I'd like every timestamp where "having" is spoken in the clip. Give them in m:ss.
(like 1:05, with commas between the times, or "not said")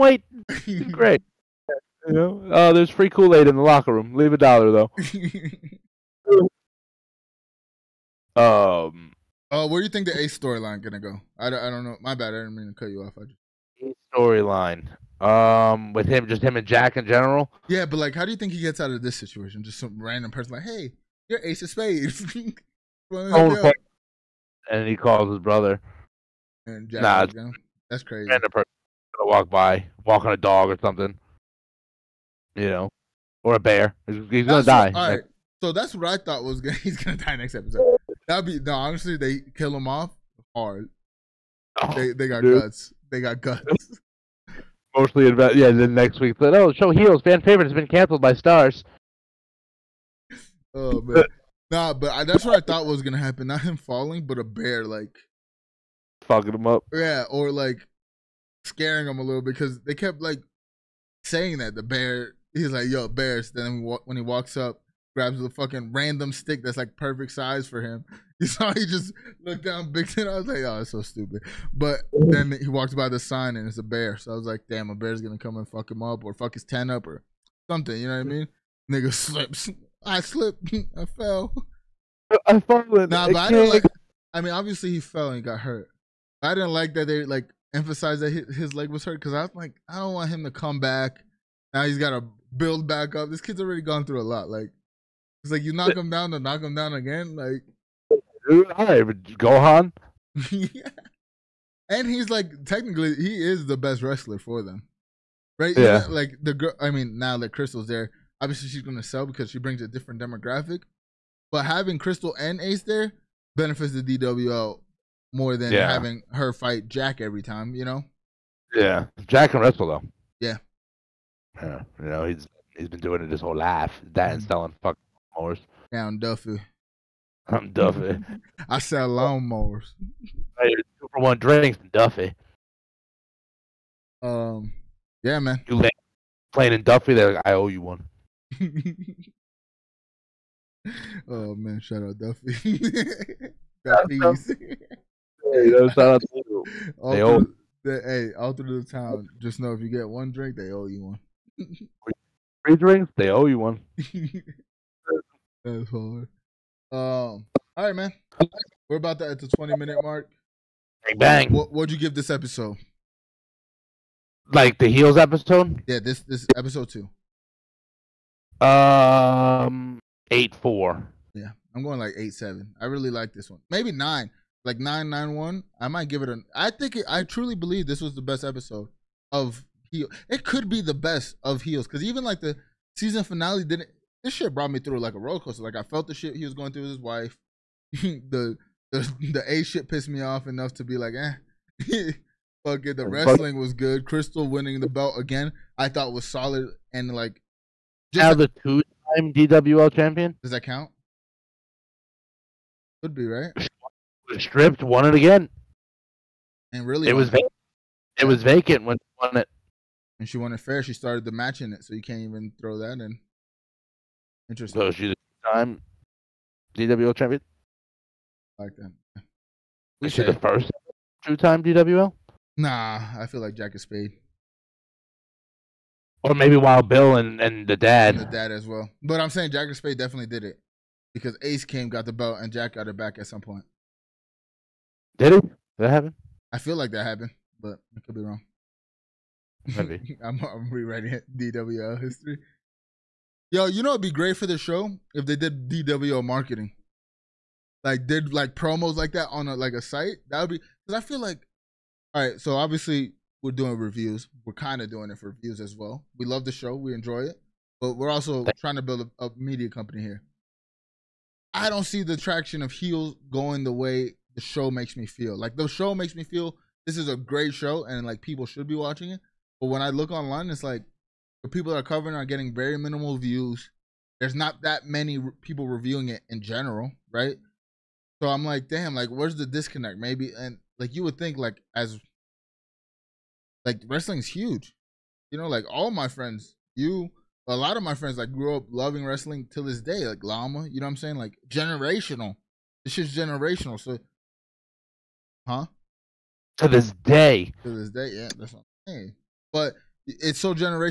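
1:51, 1:55.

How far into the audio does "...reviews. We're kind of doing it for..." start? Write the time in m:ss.
4:13.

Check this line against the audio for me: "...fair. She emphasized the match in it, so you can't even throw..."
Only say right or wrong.
wrong.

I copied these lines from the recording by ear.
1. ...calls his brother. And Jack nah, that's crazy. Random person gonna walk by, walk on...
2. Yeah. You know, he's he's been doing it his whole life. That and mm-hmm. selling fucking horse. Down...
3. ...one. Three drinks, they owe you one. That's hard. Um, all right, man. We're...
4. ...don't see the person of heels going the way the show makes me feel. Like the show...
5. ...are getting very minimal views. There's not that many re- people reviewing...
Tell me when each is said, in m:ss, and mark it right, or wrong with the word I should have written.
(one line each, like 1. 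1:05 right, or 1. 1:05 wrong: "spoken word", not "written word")
1. 0:24 right
2. 2:01 right
3. 2:31 right
4. 4:21 wrong: "traction", not "person"
5. 4:32 right.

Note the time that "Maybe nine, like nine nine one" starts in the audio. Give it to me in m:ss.
2:53.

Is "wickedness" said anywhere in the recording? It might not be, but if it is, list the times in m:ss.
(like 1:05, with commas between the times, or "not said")
not said.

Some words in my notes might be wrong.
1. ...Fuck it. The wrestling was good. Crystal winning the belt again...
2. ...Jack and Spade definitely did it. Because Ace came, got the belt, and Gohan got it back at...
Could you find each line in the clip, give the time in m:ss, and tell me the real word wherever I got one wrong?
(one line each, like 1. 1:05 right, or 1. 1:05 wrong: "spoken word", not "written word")
1. 3:12 right
2. 3:49 wrong: "Jack", not "Gohan".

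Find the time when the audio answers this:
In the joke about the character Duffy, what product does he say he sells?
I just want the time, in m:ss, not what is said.
2:09.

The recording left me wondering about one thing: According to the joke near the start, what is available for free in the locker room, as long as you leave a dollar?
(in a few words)
Kool Aid.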